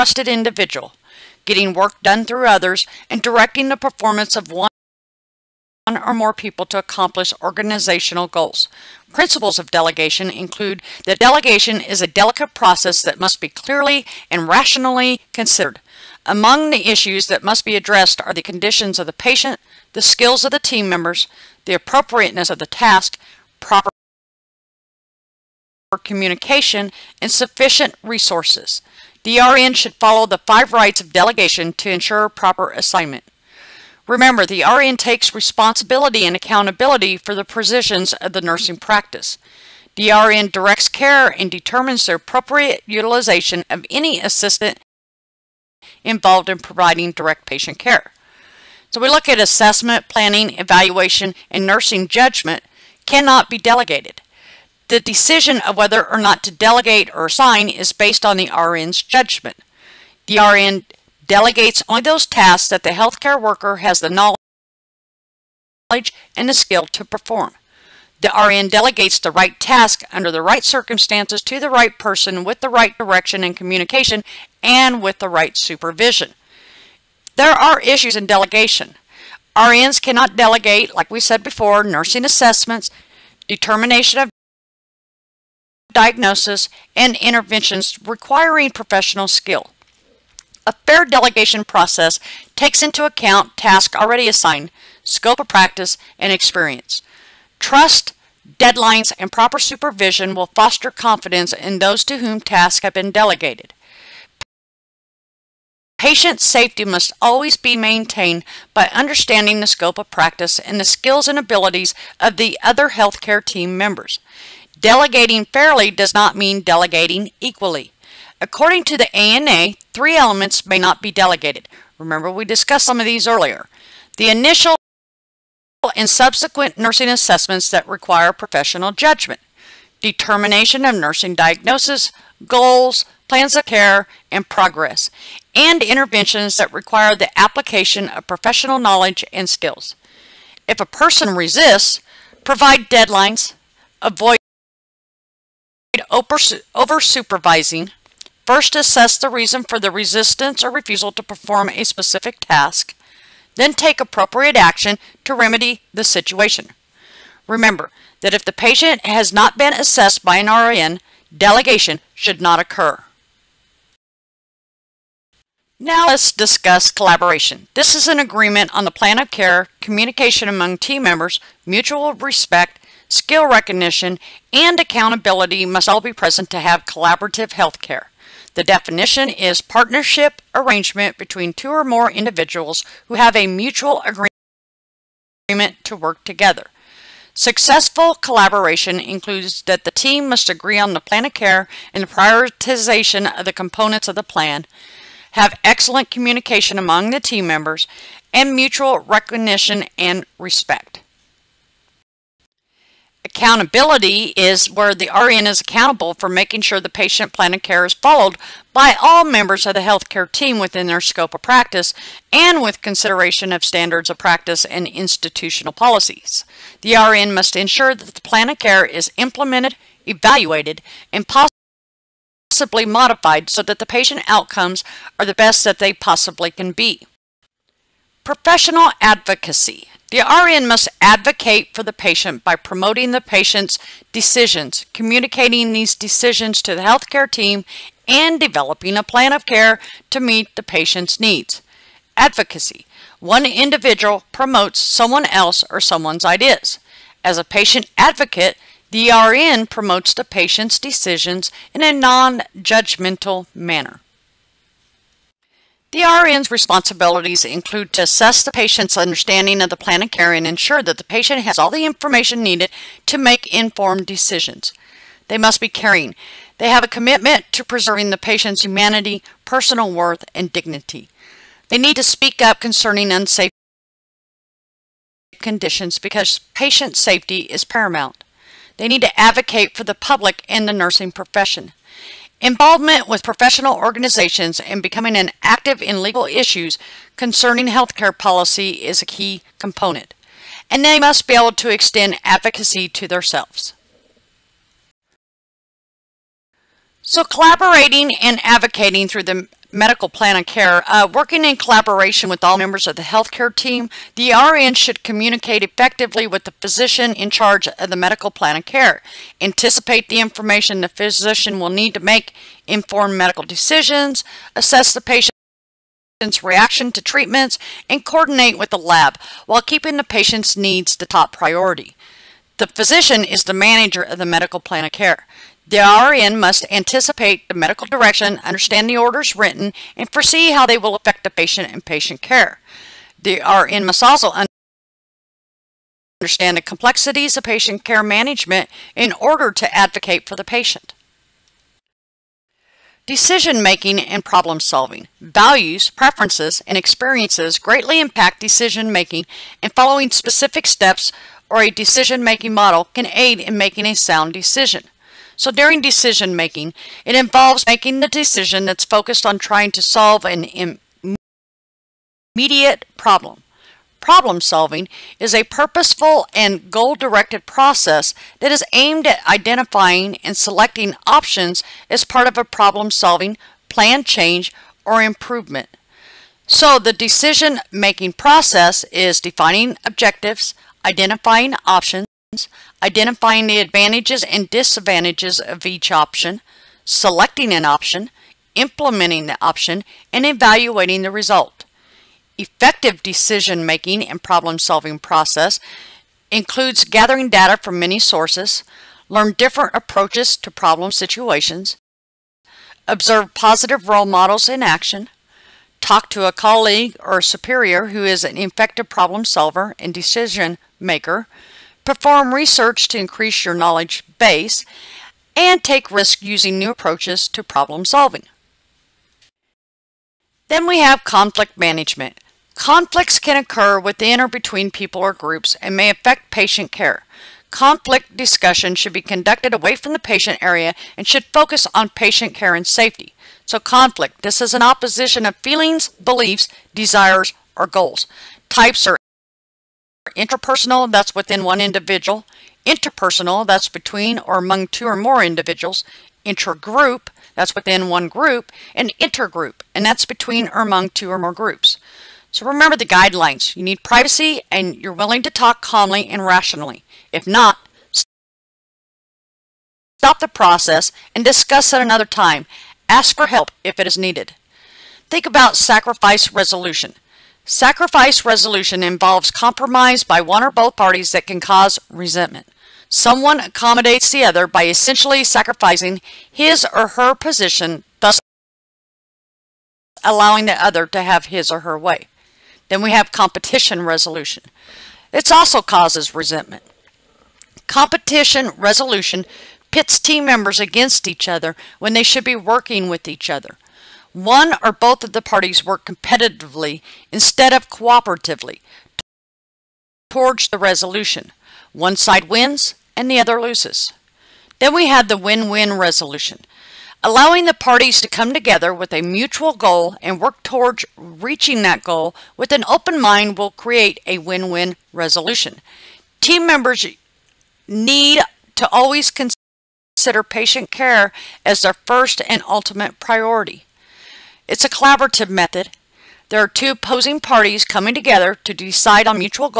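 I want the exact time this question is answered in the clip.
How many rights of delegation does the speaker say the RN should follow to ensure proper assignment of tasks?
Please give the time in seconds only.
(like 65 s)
30 s.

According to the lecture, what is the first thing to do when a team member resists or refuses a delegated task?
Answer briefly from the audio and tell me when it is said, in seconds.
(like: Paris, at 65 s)
Assess the reason, at 148 s.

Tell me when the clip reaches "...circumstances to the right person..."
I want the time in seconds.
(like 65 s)
70 s.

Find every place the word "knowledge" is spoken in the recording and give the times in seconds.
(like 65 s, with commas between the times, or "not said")
64 s, 138 s, 413 s.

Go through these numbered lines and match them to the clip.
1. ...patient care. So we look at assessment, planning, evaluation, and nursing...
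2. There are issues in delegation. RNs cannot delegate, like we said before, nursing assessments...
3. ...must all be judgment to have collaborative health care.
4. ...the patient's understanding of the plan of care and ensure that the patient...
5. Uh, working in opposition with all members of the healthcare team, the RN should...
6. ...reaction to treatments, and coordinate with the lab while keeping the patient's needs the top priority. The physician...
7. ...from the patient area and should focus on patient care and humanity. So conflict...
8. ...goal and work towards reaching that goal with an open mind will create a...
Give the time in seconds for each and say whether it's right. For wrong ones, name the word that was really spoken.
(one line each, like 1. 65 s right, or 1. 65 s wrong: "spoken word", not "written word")
1. 47 s right
2. 77 s right
3. 175 s wrong: "present", not "judgment"
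4. 258 s right
5. 300 s wrong: "collaboration", not "opposition"
6. 316 s right
7. 429 s wrong: "safety", not "humanity"
8. 509 s right.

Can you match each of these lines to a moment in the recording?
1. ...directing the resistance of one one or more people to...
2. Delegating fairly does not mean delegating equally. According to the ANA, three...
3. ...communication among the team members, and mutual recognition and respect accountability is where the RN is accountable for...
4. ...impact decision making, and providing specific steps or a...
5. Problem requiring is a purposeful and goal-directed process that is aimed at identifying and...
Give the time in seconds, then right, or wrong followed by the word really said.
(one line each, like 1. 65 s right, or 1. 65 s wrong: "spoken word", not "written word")
1. 3 s wrong: "performance", not "resistance"
2. 114 s right
3. 196 s right
4. 347 s wrong: "following", not "providing"
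5. 364 s wrong: "solving", not "requiring".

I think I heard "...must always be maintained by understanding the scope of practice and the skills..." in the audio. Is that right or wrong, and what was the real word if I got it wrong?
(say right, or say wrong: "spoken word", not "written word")
right.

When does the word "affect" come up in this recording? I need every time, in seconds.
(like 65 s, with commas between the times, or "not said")
330 s, 425 s.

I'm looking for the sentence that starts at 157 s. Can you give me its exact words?
Remember that if the patient has not been assessed by an RN, delegation should not occur.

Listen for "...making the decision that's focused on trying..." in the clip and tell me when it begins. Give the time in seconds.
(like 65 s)
357 s.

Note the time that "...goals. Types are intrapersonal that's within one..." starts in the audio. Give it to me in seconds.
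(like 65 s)
437 s.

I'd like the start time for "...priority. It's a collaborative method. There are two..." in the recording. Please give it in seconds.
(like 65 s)
522 s.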